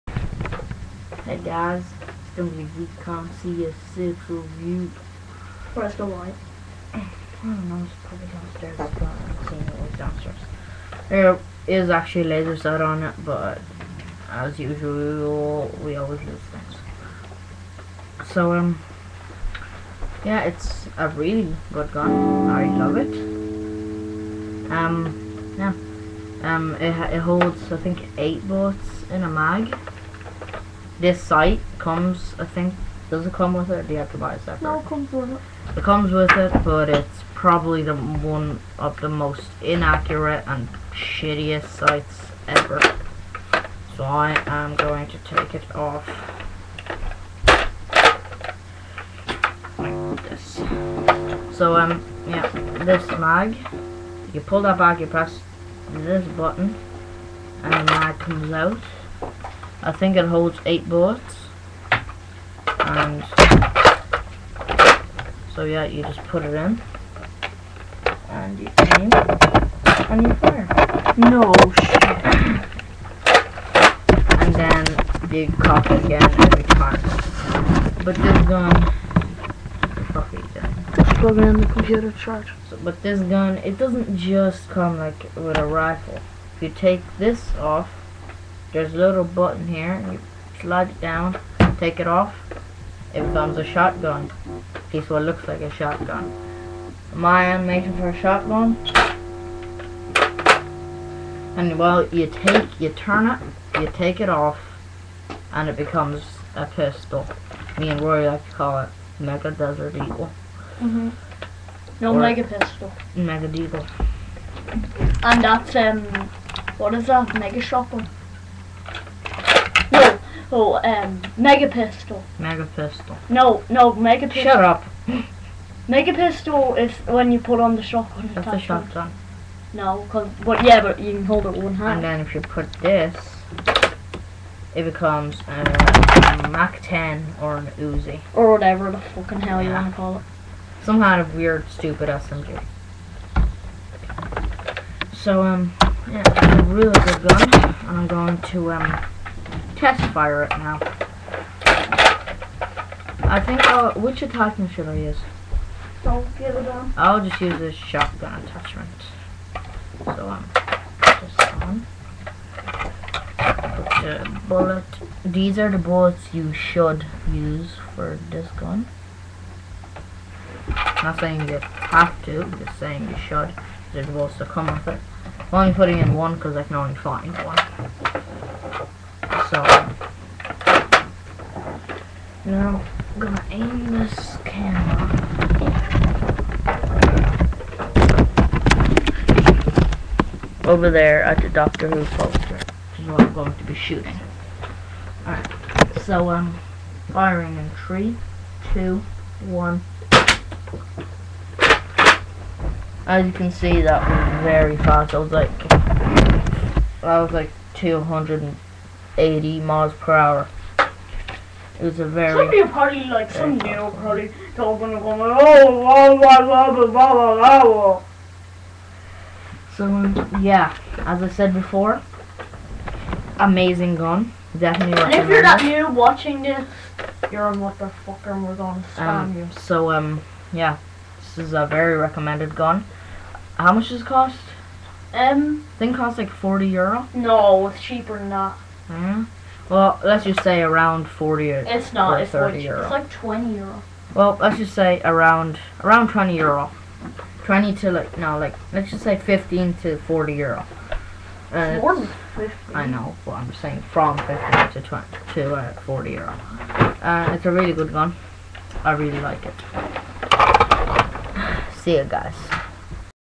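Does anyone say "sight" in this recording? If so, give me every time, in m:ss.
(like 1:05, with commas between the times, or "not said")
0:12, 0:31, 0:41.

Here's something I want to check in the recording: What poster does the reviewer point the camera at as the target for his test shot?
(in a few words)
Doctor Who poster.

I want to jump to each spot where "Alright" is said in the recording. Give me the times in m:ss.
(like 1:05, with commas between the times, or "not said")
3:15.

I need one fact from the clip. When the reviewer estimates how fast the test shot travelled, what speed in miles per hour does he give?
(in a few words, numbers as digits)
80.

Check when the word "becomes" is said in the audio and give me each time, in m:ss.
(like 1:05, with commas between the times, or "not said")
1:33, 1:45, 2:14.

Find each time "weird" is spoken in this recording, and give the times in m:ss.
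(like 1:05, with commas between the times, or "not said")
2:21.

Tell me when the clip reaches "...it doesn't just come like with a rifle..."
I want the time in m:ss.
1:23.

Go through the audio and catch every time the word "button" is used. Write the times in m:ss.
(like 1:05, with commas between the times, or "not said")
0:56, 1:29.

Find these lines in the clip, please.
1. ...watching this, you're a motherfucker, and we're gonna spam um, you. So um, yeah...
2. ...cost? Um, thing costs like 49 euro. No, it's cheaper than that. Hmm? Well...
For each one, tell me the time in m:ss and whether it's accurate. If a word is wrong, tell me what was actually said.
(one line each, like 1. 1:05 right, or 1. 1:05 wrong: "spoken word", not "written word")
1. 3:45 right
2. 3:54 wrong: "40", not "49".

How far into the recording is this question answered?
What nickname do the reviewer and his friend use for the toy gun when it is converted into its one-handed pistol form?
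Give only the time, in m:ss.
1:49.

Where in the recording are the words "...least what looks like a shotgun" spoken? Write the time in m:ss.
1:34.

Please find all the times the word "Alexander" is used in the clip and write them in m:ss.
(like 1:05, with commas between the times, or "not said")
not said.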